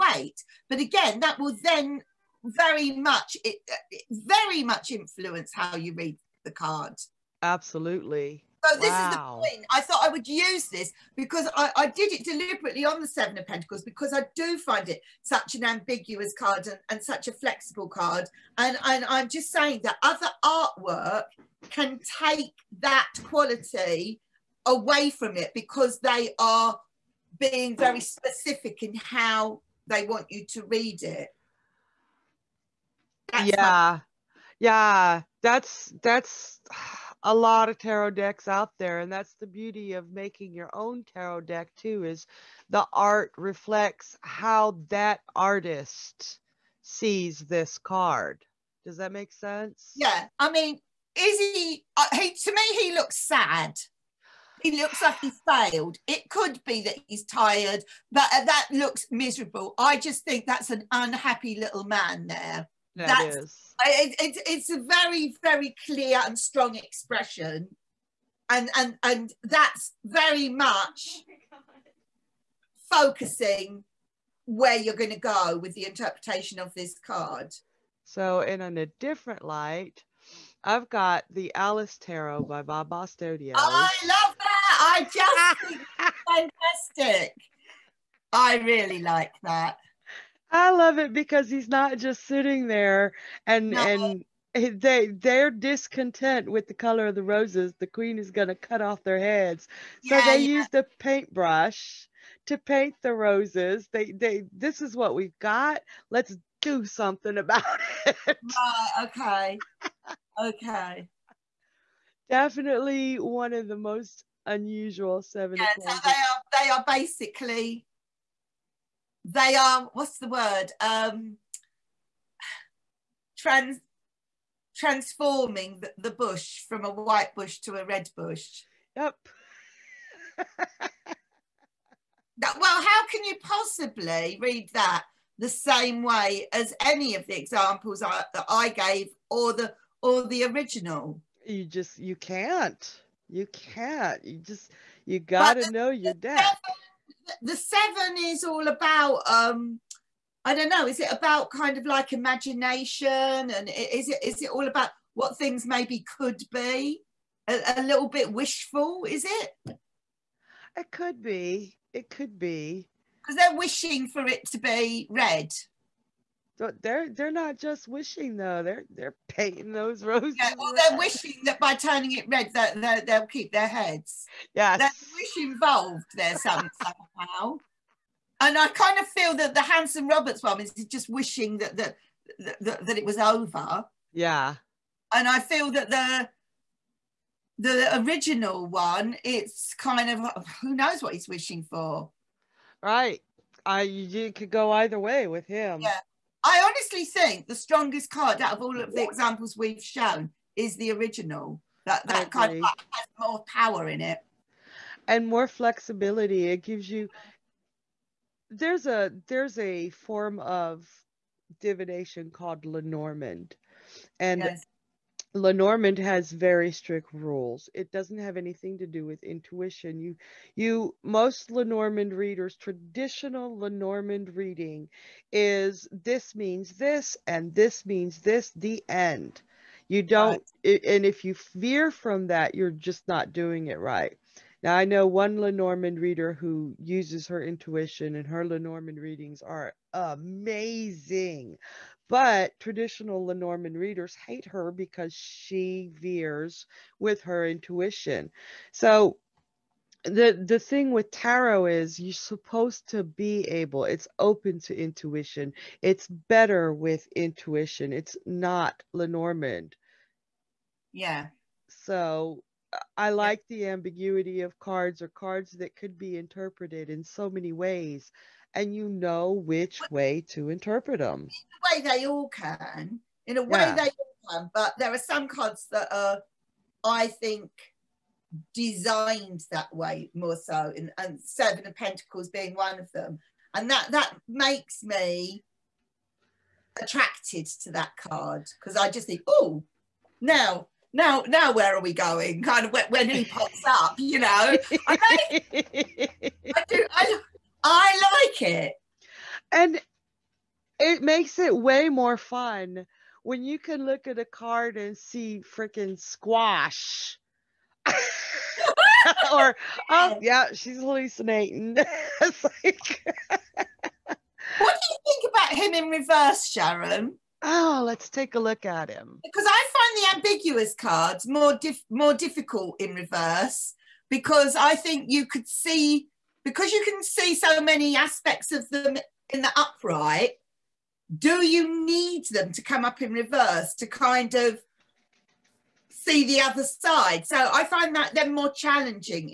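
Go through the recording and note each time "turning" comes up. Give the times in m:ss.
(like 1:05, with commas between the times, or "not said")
2:51.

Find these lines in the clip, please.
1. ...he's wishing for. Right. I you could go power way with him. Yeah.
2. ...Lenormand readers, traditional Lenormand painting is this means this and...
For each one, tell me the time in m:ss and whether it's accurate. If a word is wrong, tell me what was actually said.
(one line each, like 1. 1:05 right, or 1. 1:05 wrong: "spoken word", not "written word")
1. 3:11 wrong: "either", not "power"
2. 3:41 wrong: "reading", not "painting".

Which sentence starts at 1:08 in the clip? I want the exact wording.
And, and, and that's very much focusing where you're going to go with the interpretation of this card.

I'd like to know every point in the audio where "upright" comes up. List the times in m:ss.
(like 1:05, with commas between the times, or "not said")
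5:29.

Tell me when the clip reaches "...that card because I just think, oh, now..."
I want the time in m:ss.
4:47.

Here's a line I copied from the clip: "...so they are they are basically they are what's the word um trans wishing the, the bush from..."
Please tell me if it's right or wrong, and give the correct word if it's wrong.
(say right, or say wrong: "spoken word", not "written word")
wrong: "transforming", not "wishing".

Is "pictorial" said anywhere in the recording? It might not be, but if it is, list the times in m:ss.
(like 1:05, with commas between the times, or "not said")
not said.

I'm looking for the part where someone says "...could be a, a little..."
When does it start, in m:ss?
2:36.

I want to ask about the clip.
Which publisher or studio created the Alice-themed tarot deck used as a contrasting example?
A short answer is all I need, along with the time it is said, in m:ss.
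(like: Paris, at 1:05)
Baba Studio, at 1:22.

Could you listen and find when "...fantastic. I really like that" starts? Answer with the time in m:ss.
1:26.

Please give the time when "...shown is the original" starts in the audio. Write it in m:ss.
3:19.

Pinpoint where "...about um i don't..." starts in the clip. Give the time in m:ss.
2:28.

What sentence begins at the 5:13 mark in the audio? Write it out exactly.
what do you think about him in reverse sharon Oh, let's take a look at him.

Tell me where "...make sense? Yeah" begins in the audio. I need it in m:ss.
0:49.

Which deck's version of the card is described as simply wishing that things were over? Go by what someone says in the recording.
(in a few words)
Hanson Roberts.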